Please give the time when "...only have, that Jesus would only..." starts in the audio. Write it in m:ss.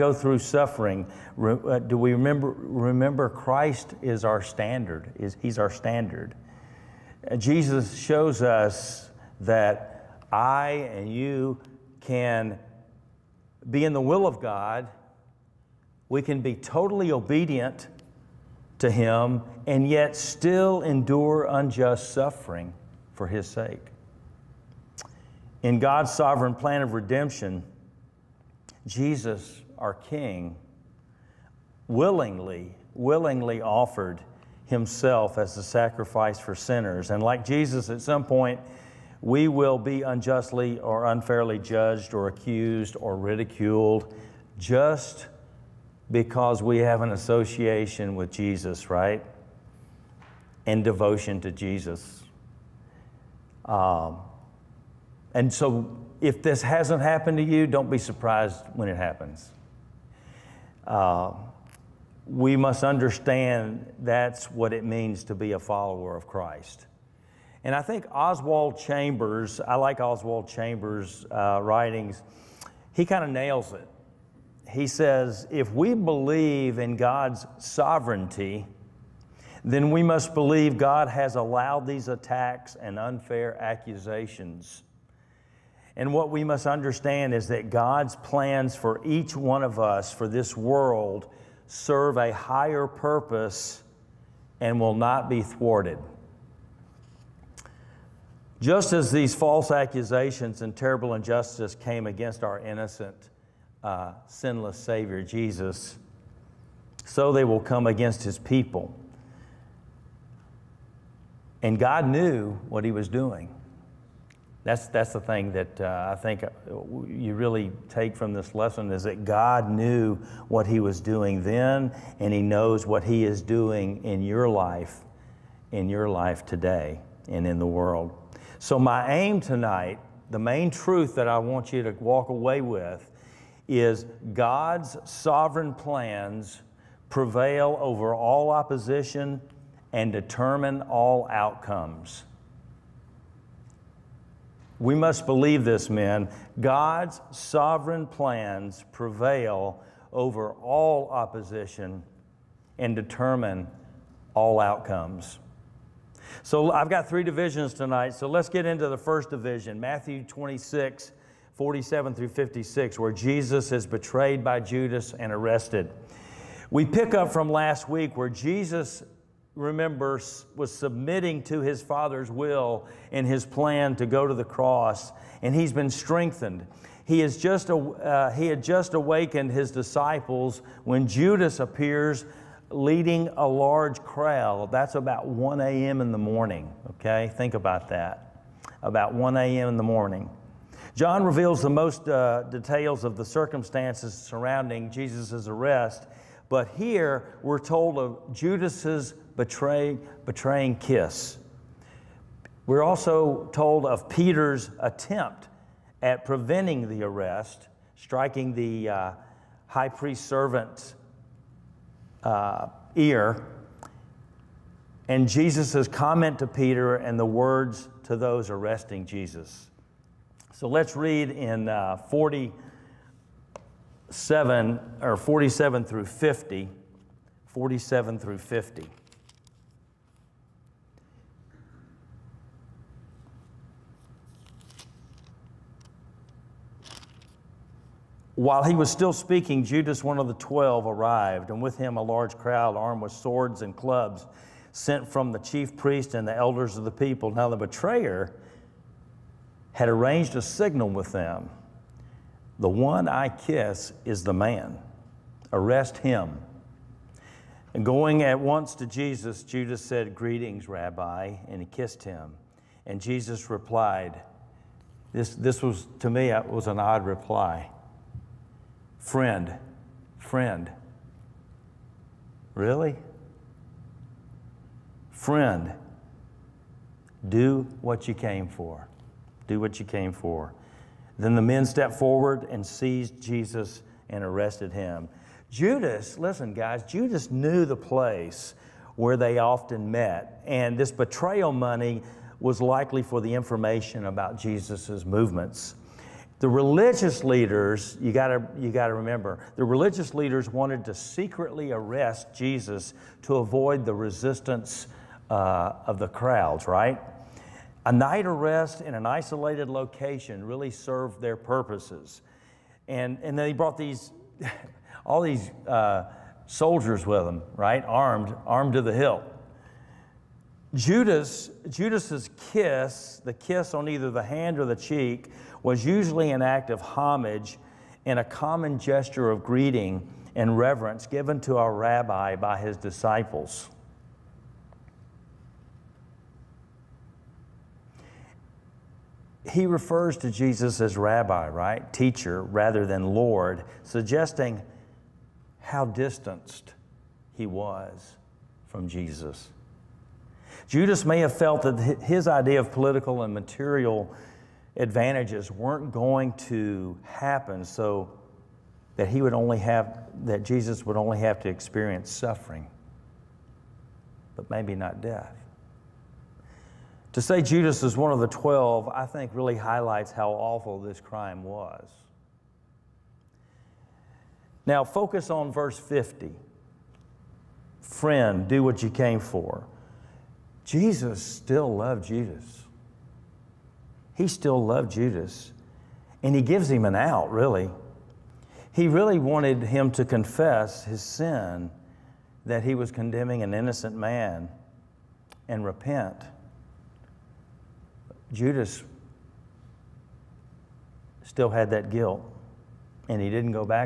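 5:59.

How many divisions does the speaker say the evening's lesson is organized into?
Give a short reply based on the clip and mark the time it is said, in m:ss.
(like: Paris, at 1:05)
3, at 2:37.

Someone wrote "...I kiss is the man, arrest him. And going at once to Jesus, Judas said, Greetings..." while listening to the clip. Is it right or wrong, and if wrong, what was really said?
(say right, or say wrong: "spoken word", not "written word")
right.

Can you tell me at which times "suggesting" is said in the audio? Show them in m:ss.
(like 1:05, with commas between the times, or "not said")
5:43.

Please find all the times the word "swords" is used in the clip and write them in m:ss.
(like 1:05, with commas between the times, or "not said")
4:03.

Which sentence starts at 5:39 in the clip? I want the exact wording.
He refers to Jesus as rabbi, right?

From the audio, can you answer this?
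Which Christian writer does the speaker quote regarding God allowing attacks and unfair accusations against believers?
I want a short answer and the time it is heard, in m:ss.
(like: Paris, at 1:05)
Oswald Chambers, at 1:08.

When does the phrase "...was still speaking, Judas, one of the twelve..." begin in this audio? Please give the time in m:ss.
3:58.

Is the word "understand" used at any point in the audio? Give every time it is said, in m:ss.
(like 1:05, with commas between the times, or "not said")
1:02, 1:26.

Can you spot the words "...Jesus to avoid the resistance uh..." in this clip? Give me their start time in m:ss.
5:02.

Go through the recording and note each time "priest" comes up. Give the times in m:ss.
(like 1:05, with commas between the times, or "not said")
3:29, 4:05.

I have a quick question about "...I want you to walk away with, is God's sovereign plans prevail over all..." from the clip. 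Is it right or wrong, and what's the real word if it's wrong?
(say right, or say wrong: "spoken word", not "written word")
right.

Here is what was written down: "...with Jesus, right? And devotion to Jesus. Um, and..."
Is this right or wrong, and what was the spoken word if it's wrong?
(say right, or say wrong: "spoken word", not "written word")
right.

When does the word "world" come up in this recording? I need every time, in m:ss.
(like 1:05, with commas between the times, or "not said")
1:30, 2:07.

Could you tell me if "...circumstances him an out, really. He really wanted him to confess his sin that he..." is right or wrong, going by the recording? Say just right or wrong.
wrong.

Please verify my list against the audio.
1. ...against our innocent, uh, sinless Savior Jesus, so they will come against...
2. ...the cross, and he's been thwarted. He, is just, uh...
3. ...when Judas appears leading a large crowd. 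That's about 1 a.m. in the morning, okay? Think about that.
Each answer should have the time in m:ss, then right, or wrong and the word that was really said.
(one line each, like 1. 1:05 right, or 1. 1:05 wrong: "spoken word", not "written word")
1. 1:42 right
2. 2:54 wrong: "strengthened", not "thwarted"
3. 3:00 right.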